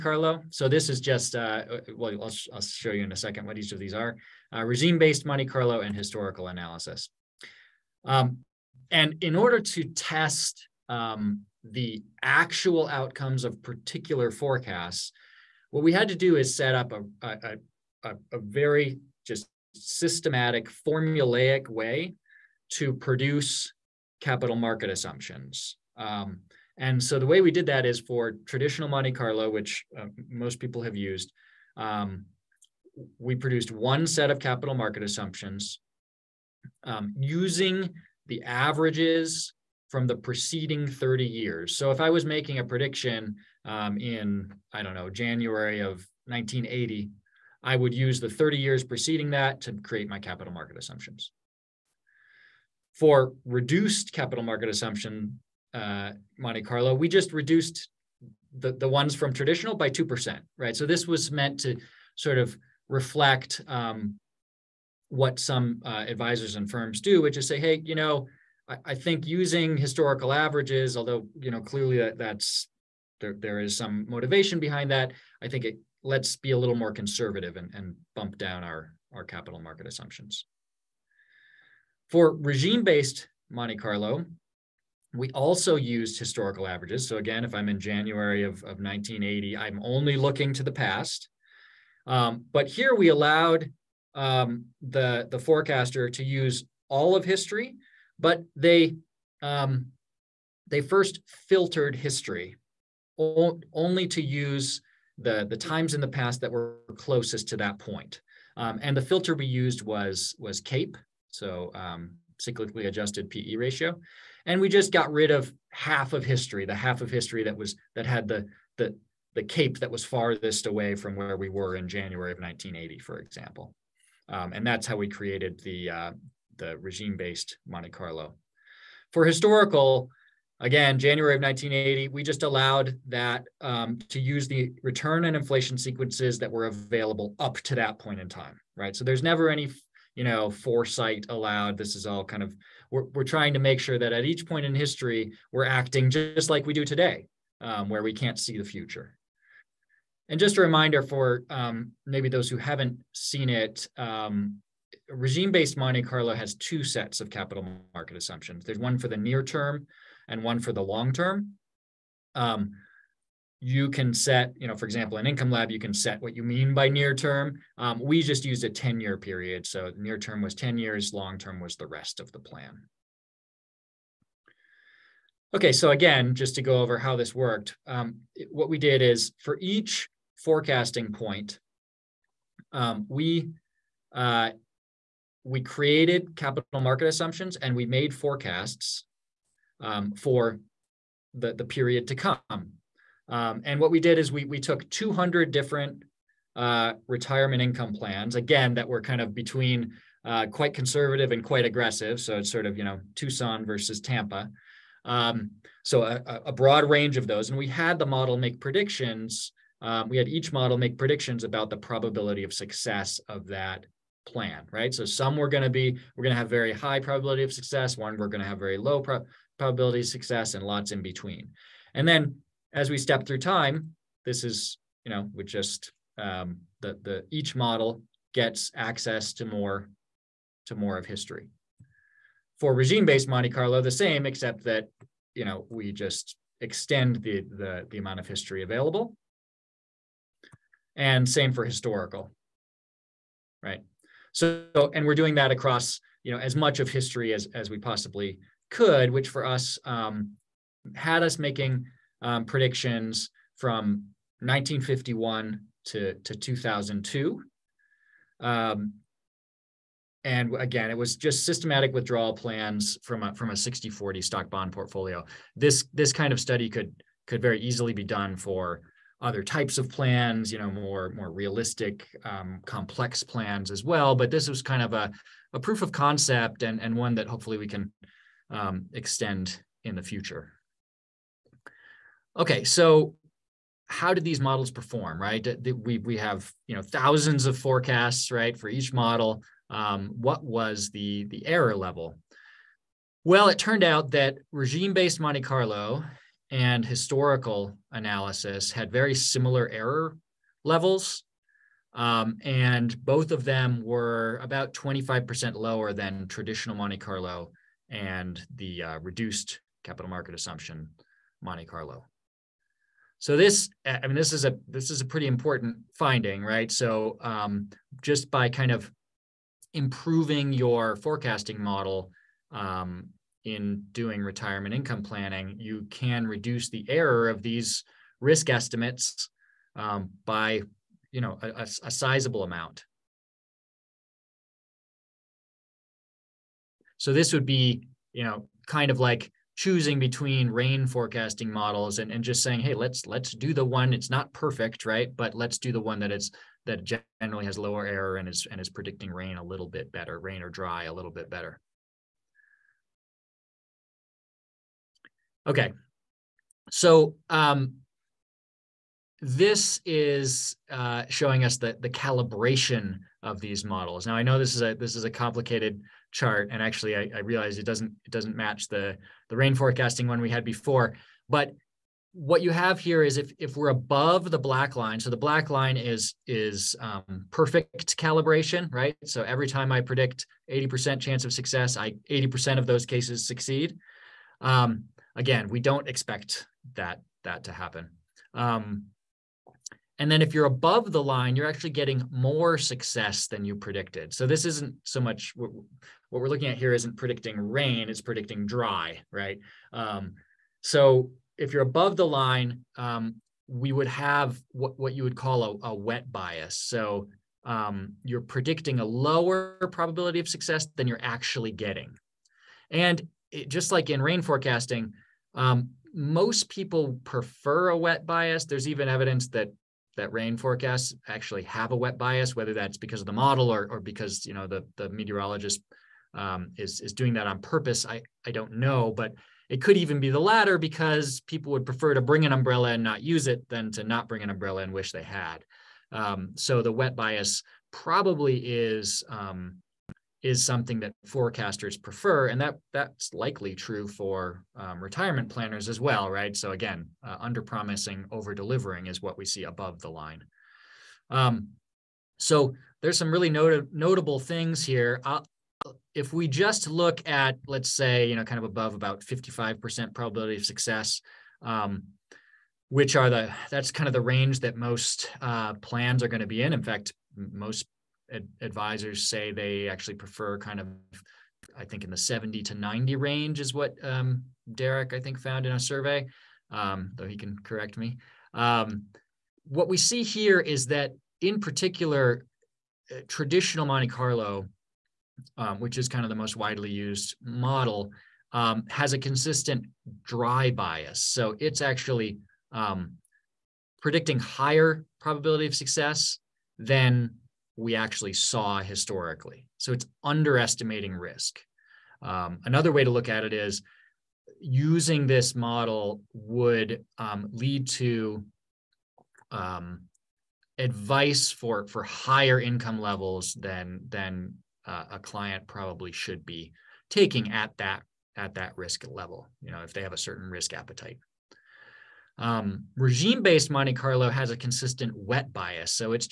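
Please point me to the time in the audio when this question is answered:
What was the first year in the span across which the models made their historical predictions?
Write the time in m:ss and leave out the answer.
4:14.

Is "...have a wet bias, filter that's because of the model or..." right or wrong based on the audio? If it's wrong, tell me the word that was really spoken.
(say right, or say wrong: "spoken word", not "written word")
wrong: "whether", not "filter".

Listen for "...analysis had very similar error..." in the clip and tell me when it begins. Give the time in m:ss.
4:57.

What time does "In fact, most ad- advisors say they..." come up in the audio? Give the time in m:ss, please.
7:46.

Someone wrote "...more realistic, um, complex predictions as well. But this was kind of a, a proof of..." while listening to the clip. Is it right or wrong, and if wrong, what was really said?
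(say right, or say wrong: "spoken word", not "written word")
wrong: "plans", not "predictions".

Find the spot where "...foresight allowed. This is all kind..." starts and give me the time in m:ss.
2:20.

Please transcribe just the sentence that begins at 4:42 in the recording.
Okay, so how did these models perform, right?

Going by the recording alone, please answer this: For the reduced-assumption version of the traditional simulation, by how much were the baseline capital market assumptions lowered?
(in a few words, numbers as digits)
2%.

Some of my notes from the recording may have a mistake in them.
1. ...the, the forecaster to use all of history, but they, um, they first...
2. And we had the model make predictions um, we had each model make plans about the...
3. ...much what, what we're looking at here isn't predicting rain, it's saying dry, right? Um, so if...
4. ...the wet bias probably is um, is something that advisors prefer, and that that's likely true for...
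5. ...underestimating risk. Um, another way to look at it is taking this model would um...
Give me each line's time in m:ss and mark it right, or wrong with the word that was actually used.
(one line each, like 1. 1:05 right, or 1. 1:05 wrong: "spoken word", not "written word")
1. 1:34 right
2. 3:27 wrong: "predictions", not "plans"
3. 6:34 wrong: "predicting", not "saying"
4. 7:16 wrong: "forecasters", not "advisors"
5. 8:20 wrong: "using", not "taking".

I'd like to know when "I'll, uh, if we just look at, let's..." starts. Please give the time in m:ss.
7:35.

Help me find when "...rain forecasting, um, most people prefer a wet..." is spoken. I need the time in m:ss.
6:54.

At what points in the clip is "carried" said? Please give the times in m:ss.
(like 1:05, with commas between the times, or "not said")
not said.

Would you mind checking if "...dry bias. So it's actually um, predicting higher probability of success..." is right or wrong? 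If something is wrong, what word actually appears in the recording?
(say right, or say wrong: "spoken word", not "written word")
right.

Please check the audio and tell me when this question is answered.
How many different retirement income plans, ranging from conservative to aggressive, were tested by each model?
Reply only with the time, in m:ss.
3:14.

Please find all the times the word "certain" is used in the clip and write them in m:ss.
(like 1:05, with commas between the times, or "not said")
8:39.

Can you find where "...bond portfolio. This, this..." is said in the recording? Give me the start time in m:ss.
4:24.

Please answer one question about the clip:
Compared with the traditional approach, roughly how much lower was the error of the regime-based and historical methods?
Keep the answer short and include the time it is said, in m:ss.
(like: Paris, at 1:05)
25%, at 5:04.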